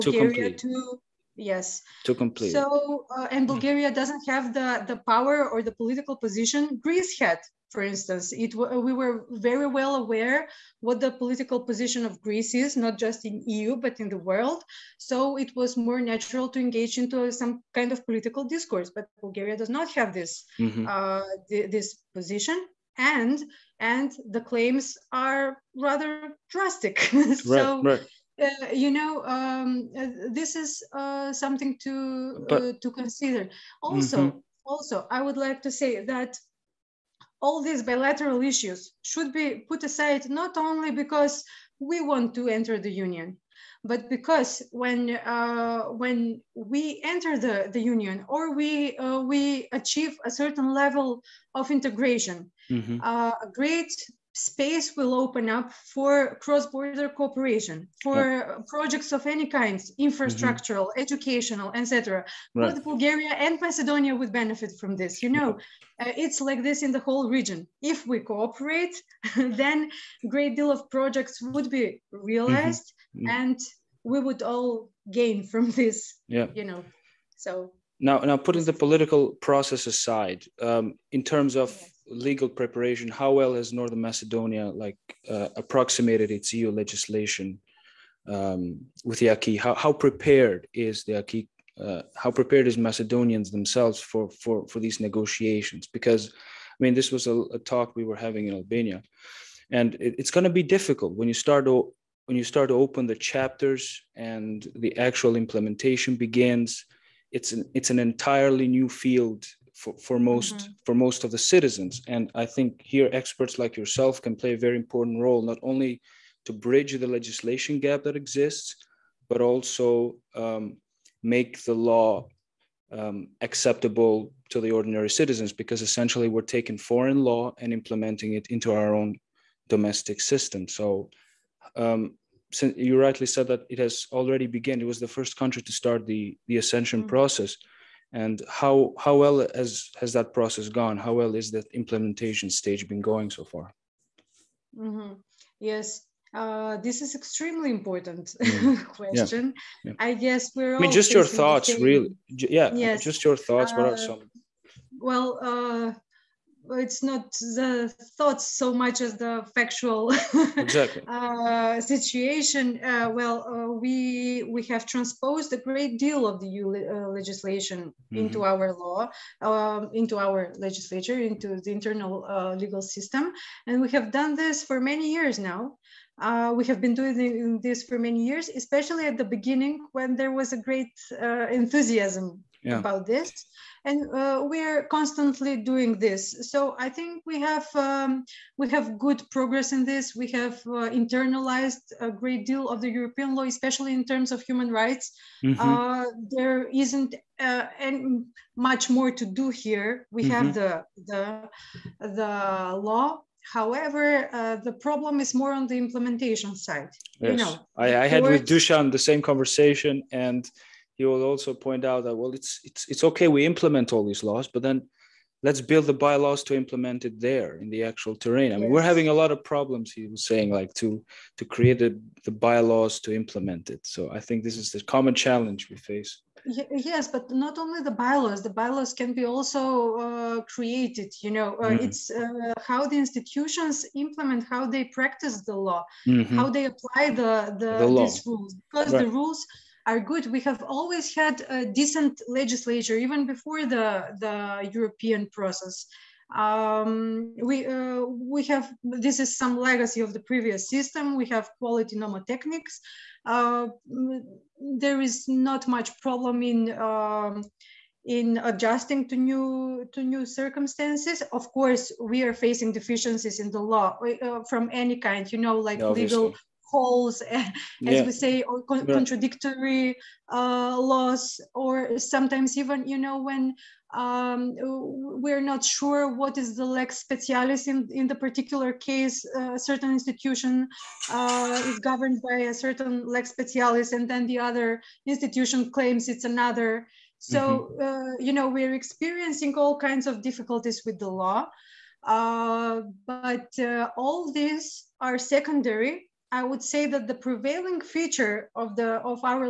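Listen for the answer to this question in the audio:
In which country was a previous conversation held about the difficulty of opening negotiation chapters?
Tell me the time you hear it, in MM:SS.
01:38.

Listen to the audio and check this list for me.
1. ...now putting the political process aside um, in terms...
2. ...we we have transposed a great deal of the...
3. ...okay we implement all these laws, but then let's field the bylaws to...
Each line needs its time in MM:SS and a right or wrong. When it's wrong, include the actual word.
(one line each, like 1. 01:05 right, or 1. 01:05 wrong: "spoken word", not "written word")
1. 01:18 right
2. 02:43 right
3. 03:33 wrong: "build", not "field".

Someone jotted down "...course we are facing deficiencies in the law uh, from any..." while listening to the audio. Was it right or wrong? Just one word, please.
right.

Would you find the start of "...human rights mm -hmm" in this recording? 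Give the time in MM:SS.
03:14.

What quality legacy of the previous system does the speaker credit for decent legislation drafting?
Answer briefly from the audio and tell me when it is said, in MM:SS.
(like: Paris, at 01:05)
nomotechnics, at 04:11.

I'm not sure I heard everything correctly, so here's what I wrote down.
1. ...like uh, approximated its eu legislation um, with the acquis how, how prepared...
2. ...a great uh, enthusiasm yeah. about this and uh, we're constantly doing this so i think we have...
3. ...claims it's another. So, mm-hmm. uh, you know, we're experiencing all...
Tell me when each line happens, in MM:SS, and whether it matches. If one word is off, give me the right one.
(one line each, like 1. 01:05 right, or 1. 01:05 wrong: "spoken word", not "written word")
1. 01:24 right
2. 03:00 right
3. 04:45 right.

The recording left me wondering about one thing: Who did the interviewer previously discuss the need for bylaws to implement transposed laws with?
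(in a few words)
Dusan.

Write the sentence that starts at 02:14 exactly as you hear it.
It was the first country to start the the ascension mm-hmm.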